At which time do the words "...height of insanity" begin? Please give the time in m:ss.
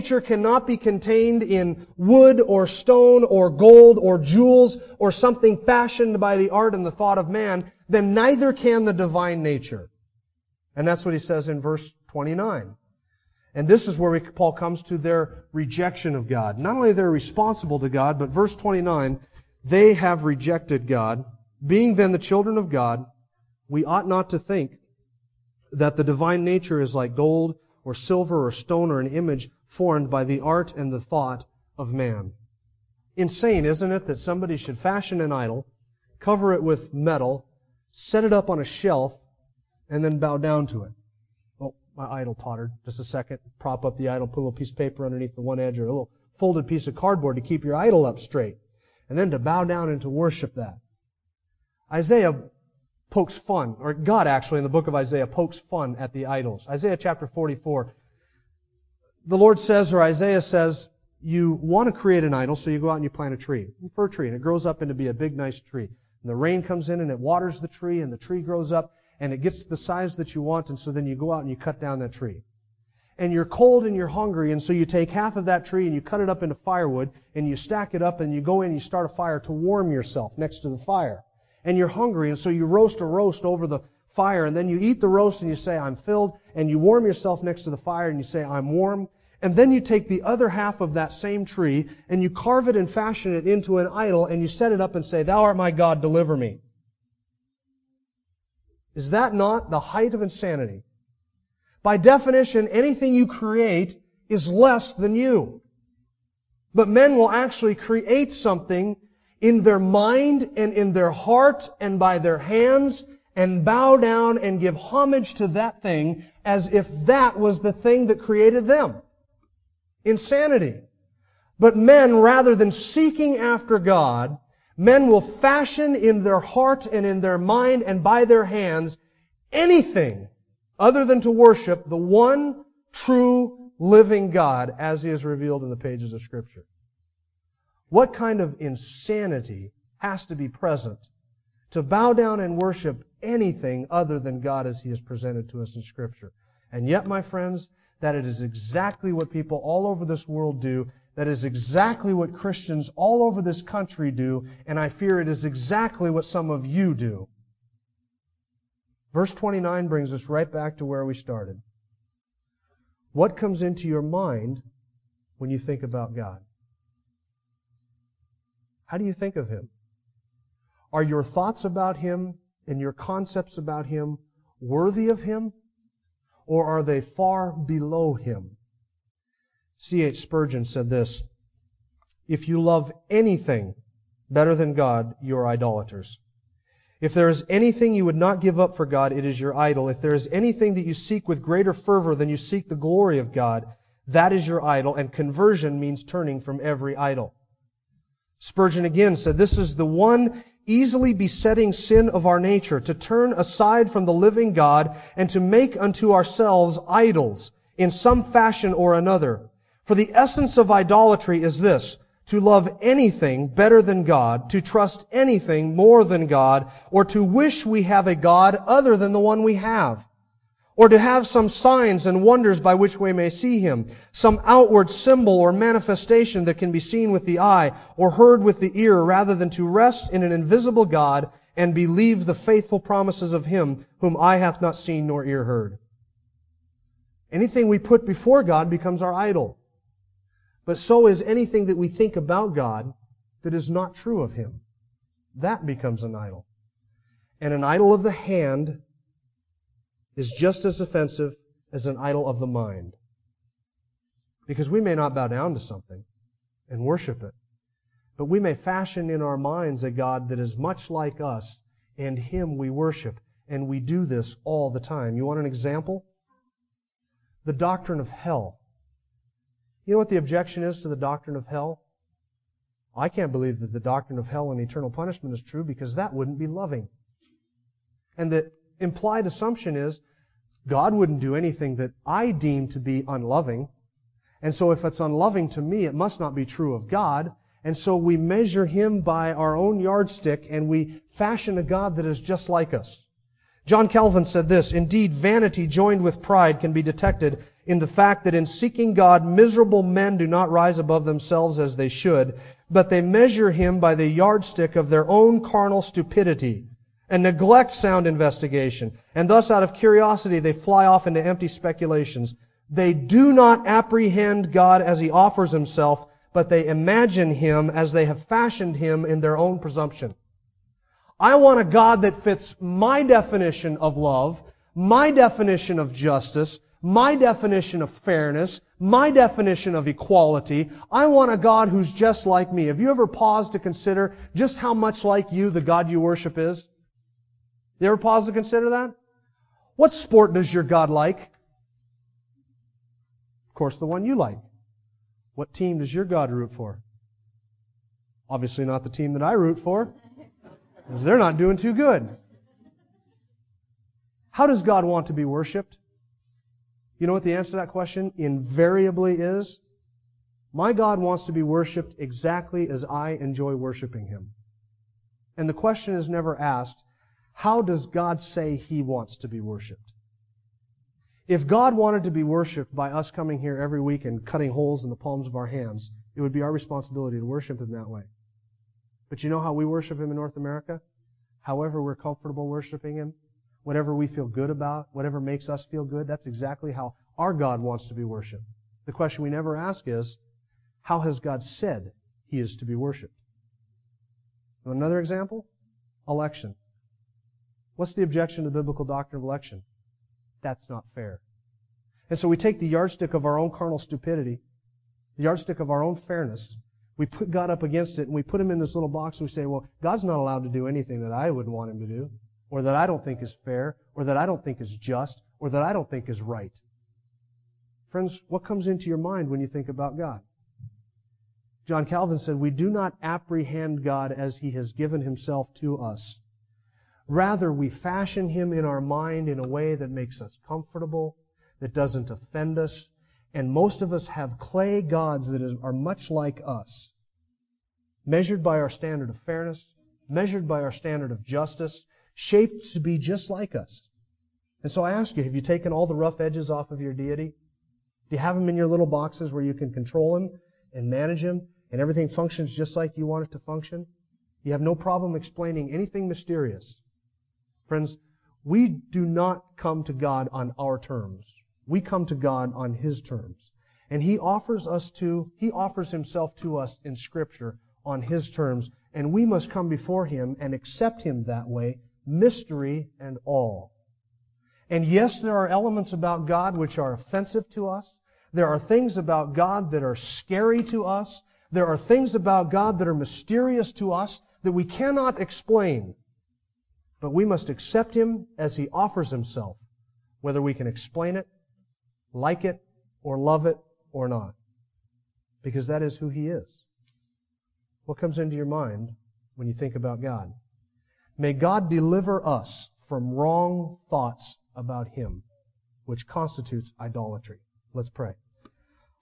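1:39.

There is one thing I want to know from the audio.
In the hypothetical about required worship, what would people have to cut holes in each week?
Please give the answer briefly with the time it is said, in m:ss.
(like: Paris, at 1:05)
palms of our hands, at 6:14.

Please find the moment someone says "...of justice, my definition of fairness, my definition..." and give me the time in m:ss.
5:25.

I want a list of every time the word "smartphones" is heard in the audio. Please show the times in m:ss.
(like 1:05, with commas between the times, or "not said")
not said.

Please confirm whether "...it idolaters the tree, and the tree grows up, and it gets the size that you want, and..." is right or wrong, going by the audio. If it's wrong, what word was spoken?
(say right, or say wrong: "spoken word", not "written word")
wrong: "waters", not "idolaters".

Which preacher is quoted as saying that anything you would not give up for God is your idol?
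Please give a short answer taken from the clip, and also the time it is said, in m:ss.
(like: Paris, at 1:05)
C.H. Spurgeon, at 2:59.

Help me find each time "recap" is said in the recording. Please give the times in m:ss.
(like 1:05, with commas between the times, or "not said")
not said.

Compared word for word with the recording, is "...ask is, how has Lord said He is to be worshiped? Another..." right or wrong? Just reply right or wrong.
wrong.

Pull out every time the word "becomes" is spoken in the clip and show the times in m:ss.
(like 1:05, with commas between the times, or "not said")
3:58, 4:05.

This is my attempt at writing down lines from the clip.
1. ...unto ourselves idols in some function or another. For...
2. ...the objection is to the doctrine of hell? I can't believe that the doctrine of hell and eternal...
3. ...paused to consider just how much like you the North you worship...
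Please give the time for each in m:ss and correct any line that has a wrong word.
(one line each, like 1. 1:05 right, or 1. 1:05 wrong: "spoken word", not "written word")
1. 3:25 wrong: "fashion", not "function"
2. 4:30 right
3. 5:33 wrong: "God", not "North".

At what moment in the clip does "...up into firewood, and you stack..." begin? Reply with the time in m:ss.
1:16.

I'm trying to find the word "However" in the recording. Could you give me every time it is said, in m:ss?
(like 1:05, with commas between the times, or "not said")
6:21.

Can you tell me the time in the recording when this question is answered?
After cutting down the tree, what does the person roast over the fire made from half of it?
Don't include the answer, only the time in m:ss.
1:22.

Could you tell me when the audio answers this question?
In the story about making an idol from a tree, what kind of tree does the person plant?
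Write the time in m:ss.
1:03.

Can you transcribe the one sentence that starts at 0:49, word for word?
And then to bow down and to worship that.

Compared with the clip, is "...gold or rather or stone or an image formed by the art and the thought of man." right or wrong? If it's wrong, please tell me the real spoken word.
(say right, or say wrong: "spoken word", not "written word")
wrong: "silver", not "rather".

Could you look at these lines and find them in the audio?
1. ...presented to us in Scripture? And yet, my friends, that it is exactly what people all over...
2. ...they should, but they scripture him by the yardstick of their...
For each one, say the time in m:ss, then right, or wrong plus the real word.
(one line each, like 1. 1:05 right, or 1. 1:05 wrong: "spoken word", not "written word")
1. 2:25 right
2. 5:01 wrong: "measure", not "scripture".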